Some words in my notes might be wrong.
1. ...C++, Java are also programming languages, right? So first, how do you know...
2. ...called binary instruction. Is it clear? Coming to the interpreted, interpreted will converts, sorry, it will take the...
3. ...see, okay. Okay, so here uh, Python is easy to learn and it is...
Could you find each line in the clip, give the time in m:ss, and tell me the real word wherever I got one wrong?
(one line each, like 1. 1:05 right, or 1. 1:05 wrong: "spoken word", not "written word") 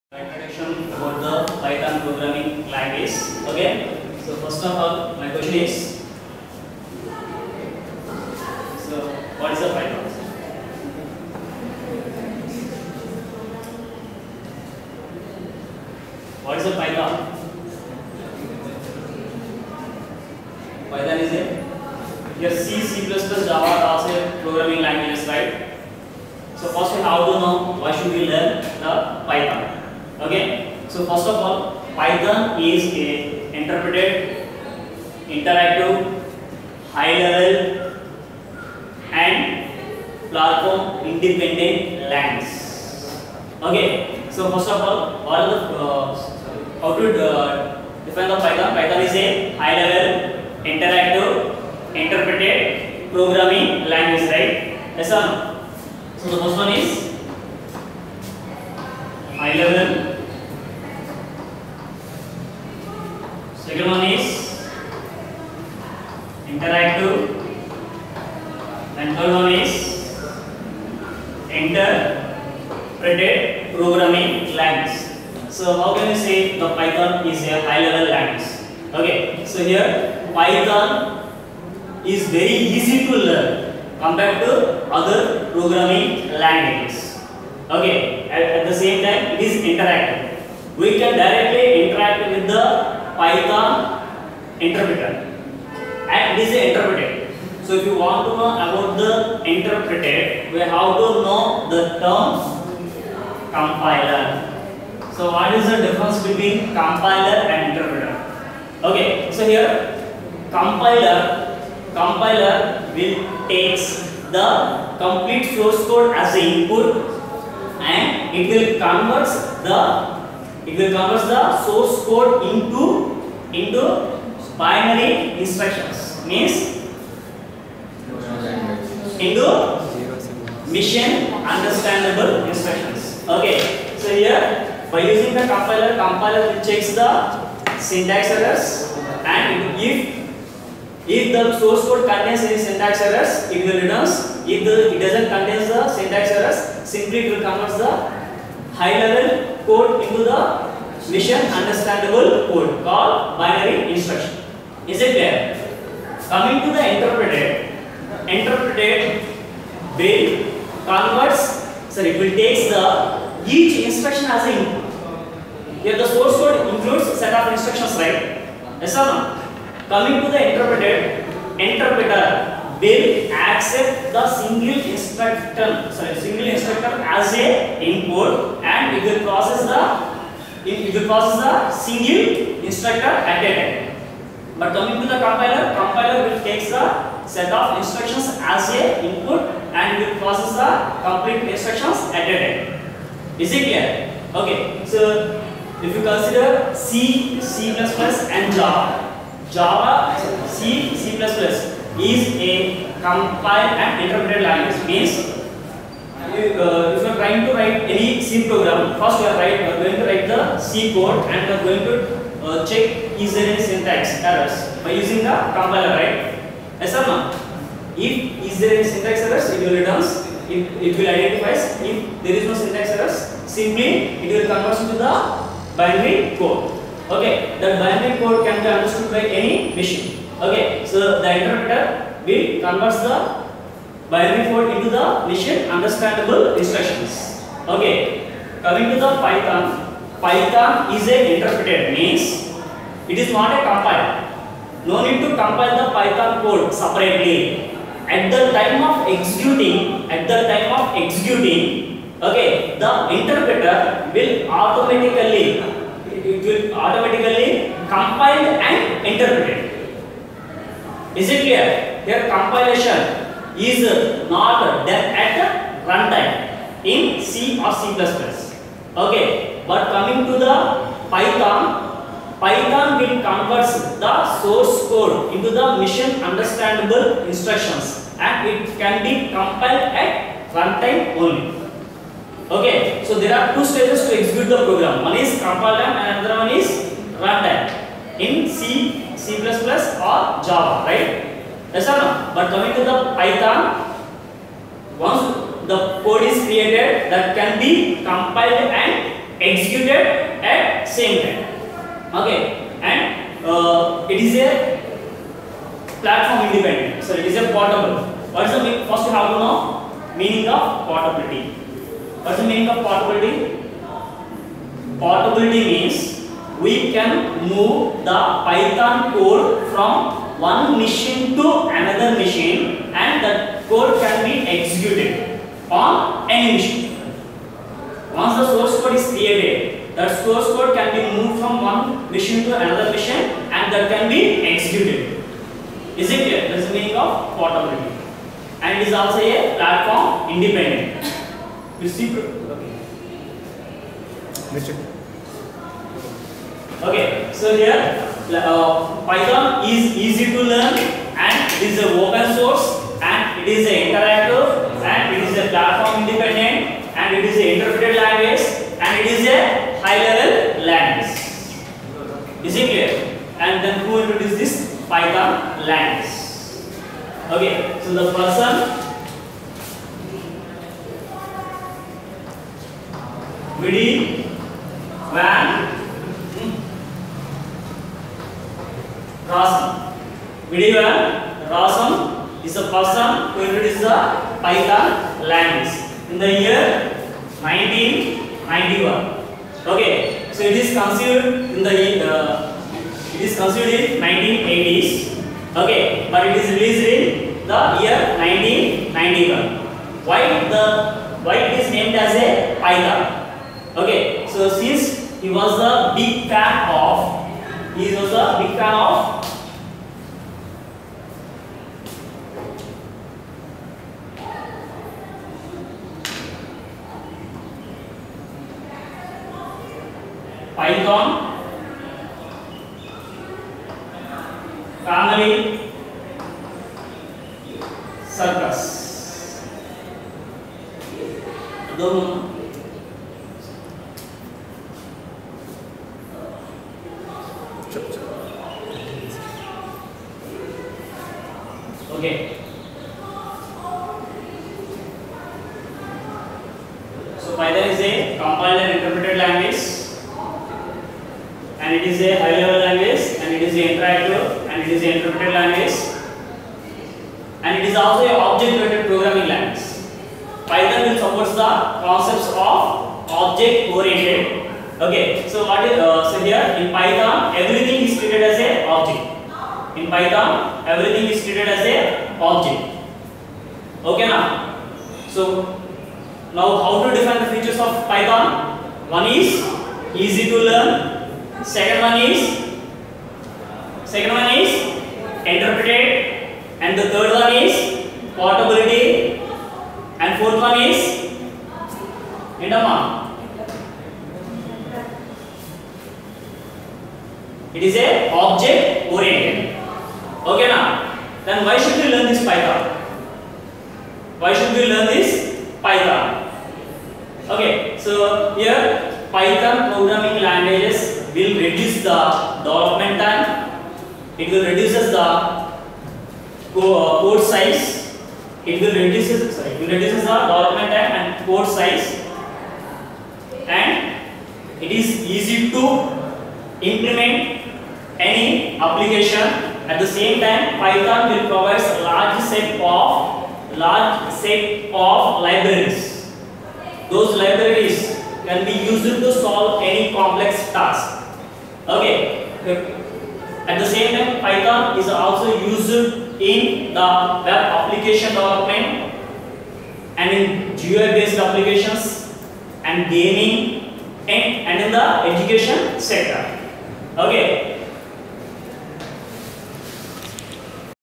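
1. 0:22 right
2. 2:32 right
3. 5:41 right.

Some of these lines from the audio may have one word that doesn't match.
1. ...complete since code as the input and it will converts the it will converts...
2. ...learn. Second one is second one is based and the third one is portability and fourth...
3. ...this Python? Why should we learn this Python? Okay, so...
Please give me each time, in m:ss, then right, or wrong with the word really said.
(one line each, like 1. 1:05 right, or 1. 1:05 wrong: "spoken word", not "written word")
1. 1:54 wrong: "source", not "since"
2. 8:00 wrong: "interpreted", not "based"
3. 8:22 right.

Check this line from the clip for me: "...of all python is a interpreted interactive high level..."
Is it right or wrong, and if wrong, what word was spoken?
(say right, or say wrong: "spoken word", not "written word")
right.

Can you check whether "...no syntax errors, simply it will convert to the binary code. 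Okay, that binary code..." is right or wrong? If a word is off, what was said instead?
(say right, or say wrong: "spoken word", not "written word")
right.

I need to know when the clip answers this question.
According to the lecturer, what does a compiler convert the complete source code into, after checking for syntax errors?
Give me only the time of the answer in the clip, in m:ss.
2:04.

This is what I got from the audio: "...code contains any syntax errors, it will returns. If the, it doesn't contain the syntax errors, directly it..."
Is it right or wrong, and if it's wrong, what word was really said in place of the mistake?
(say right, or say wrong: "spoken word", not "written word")
wrong: "simply", not "directly".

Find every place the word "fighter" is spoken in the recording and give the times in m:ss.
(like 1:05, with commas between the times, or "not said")
not said.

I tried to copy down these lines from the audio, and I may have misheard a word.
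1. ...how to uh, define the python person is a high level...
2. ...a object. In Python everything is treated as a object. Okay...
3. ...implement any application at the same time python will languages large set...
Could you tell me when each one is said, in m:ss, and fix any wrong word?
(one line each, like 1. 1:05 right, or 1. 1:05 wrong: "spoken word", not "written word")
1. 0:46 wrong: "python", not "person"
2. 7:48 right
3. 8:46 wrong: "provides", not "languages".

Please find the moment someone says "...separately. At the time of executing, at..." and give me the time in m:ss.
4:06.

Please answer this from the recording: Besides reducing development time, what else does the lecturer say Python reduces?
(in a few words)
code size.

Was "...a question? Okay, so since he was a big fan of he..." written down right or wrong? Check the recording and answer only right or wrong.
wrong.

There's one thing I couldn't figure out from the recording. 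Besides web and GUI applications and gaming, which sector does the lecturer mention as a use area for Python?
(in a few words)
education.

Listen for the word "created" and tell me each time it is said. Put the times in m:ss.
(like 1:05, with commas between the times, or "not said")
4:56, 5:29.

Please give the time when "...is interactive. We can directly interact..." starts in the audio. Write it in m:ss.
1:29.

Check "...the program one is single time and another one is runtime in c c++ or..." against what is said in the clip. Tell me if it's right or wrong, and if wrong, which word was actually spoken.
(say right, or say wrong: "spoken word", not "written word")
wrong: "compile", not "single".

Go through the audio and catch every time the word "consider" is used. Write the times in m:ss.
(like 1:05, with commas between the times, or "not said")
3:16.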